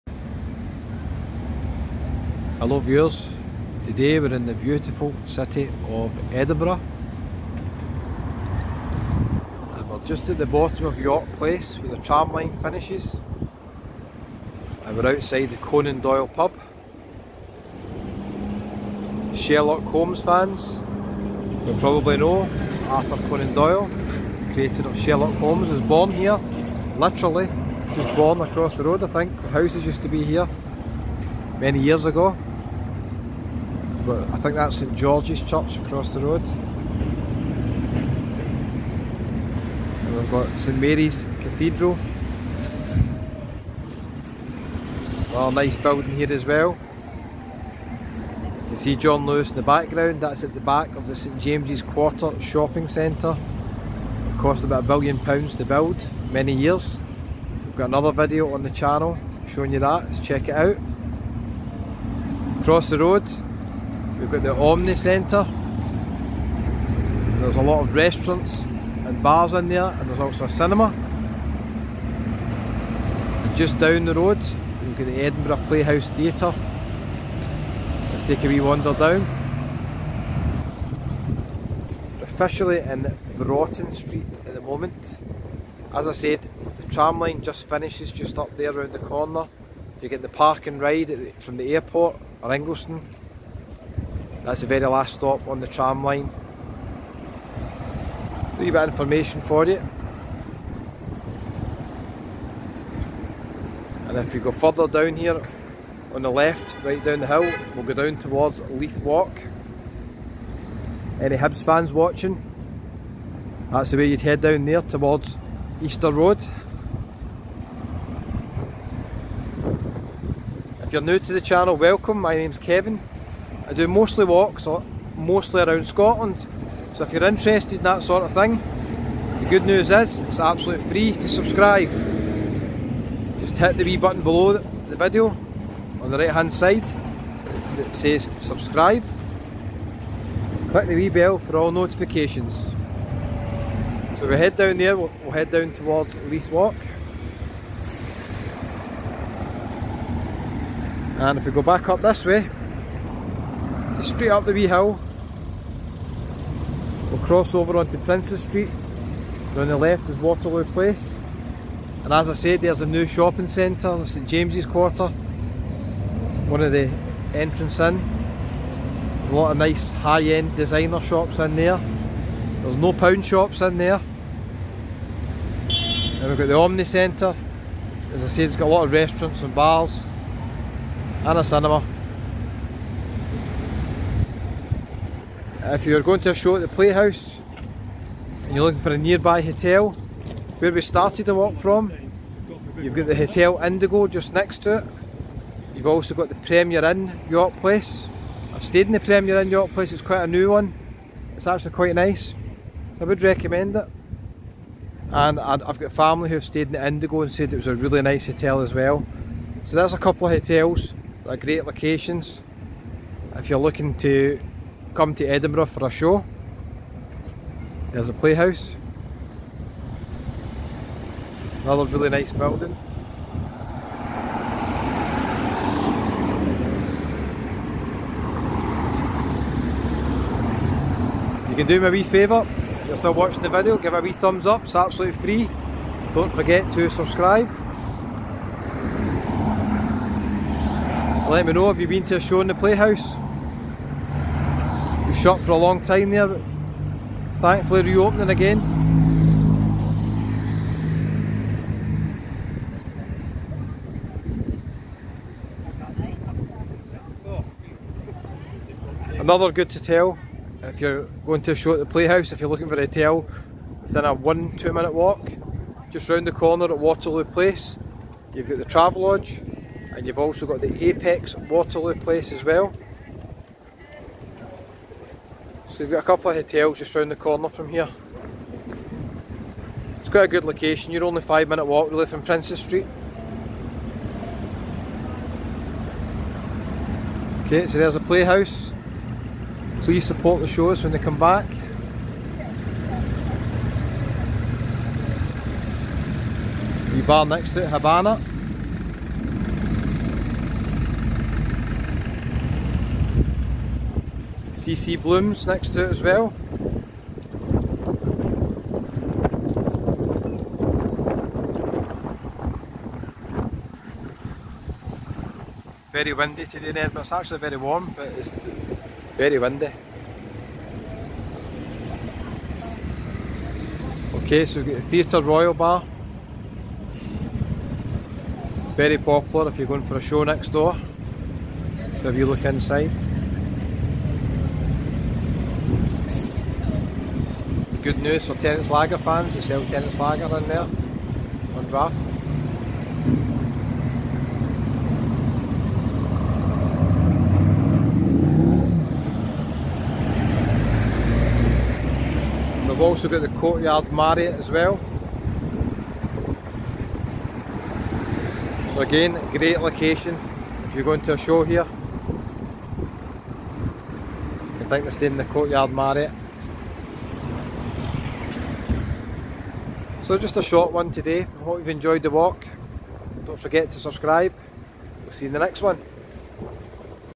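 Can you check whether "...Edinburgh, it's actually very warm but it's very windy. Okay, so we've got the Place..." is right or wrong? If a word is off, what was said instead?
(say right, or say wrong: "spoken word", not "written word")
wrong: "Theatre", not "Place".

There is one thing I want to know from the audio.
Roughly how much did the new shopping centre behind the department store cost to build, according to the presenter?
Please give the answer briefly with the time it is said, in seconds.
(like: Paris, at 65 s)
About a billion pounds, at 54 s.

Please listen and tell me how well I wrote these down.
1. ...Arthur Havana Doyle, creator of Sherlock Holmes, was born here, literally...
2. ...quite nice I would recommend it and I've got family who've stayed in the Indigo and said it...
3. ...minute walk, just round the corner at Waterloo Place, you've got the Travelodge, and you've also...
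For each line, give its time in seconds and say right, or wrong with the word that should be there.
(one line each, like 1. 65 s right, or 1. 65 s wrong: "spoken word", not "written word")
1. 22 s wrong: "Conan", not "Havana"
2. 201 s right
3. 264 s right.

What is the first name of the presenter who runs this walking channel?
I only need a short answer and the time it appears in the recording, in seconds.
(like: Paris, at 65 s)
Kevin, at 122 s.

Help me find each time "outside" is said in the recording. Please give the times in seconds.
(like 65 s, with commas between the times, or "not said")
15 s.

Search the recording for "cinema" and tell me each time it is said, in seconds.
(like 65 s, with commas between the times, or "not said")
70 s, 181 s.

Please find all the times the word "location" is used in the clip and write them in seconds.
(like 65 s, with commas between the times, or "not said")
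211 s, 280 s, 359 s.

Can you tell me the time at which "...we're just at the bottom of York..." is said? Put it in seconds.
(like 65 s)
9 s.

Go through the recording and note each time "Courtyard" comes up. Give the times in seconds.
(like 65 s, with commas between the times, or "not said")
353 s, 365 s.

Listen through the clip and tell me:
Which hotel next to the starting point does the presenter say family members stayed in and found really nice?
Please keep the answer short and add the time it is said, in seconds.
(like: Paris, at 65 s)
Hotel Indigo, at 193 s.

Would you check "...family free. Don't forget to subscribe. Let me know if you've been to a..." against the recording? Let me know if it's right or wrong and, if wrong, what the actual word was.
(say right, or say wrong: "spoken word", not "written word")
wrong: "absolutely", not "family".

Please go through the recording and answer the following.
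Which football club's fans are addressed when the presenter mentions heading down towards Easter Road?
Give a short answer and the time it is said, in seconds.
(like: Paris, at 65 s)
Hibs, at 111 s.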